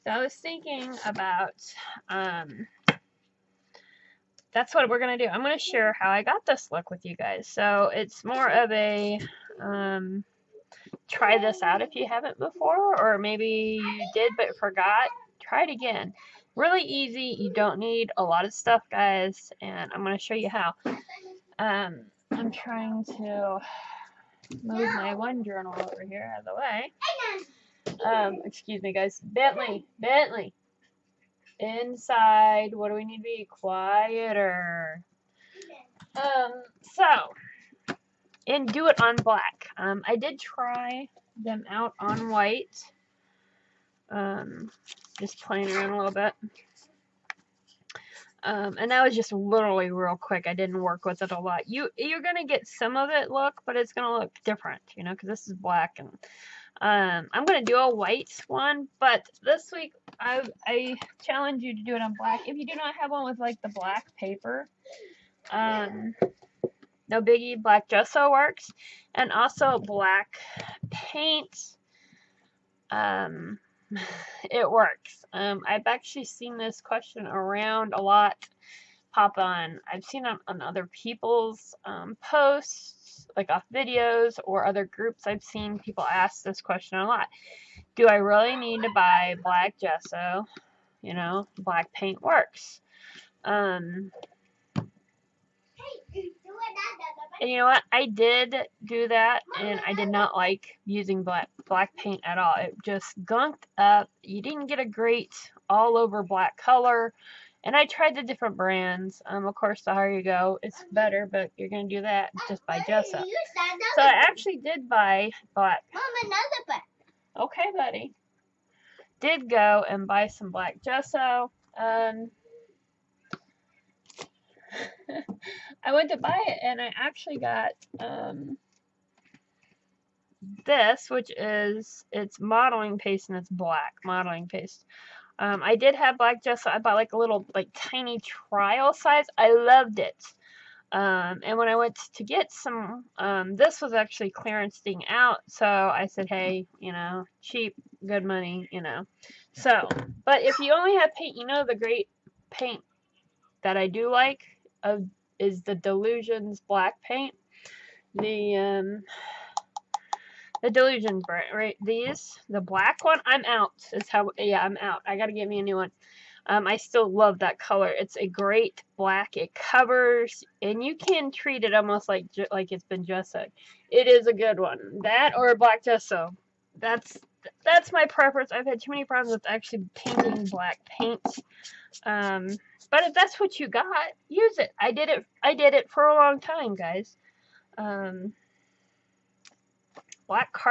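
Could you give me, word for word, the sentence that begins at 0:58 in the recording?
But this week I I challenge you to do it on black.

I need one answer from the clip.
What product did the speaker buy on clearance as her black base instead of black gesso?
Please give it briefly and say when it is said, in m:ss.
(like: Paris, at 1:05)
black modeling paste, at 2:13.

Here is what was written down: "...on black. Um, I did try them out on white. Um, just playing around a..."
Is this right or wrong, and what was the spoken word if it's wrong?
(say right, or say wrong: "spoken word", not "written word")
right.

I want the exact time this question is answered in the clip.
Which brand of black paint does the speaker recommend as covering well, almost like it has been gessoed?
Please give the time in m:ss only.
2:35.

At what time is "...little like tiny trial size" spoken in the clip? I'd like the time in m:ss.
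2:17.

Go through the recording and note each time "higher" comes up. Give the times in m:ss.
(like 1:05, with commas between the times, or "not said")
1:49.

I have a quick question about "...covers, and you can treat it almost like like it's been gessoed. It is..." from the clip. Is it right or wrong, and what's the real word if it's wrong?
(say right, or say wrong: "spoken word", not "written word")
right.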